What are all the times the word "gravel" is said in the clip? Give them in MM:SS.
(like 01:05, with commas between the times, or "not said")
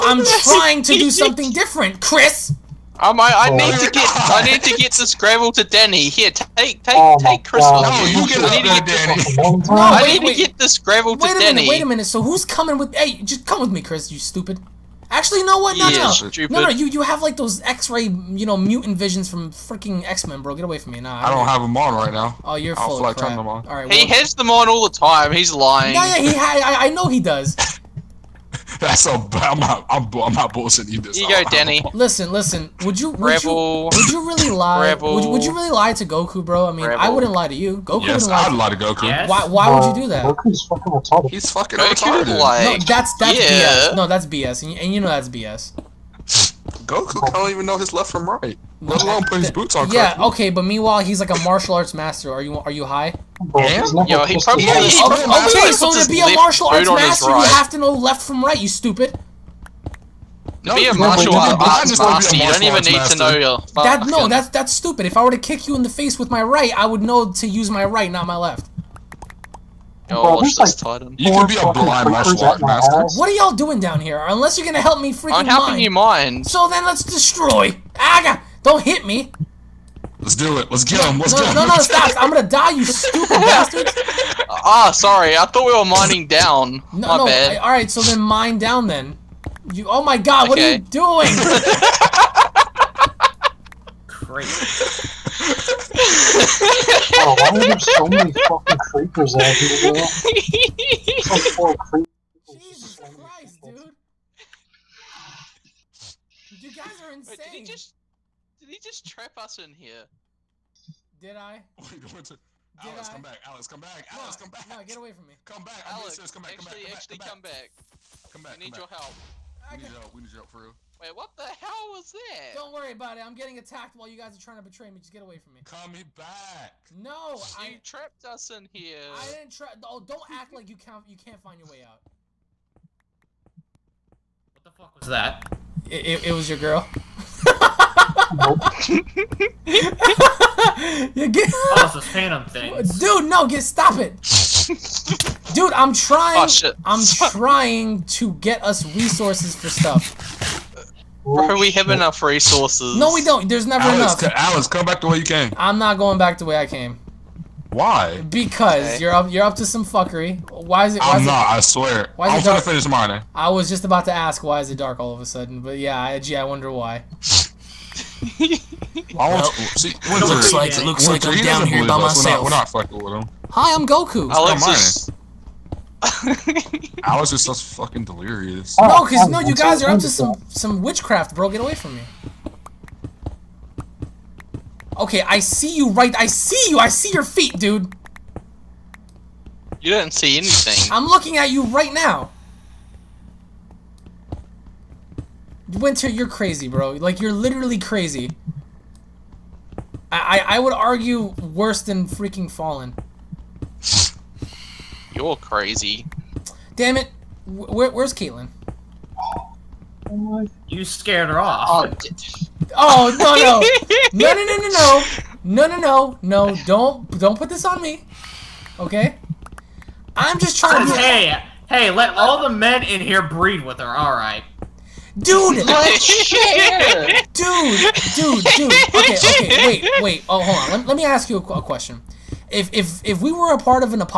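00:05, 00:10.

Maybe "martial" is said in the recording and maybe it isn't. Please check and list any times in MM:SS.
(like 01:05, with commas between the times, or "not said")
00:51, 00:56, 01:00, 01:12.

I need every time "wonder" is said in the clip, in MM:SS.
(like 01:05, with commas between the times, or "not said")
02:46.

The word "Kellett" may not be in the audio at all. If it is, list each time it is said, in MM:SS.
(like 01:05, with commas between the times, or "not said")
not said.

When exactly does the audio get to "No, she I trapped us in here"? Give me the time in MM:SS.
02:06.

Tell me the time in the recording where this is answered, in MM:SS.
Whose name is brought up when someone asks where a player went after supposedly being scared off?
03:28.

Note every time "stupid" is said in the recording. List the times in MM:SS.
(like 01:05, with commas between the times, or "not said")
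00:14, 00:58, 01:04, 01:22.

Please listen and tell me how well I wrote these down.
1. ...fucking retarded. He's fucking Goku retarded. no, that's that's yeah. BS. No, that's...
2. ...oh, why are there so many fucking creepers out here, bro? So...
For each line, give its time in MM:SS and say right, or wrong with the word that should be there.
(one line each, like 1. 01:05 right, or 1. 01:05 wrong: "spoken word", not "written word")
1. 00:40 right
2. 01:37 right.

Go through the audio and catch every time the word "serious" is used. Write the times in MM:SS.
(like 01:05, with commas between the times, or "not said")
01:56.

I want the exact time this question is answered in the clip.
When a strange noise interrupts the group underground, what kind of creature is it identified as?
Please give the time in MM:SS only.
02:22.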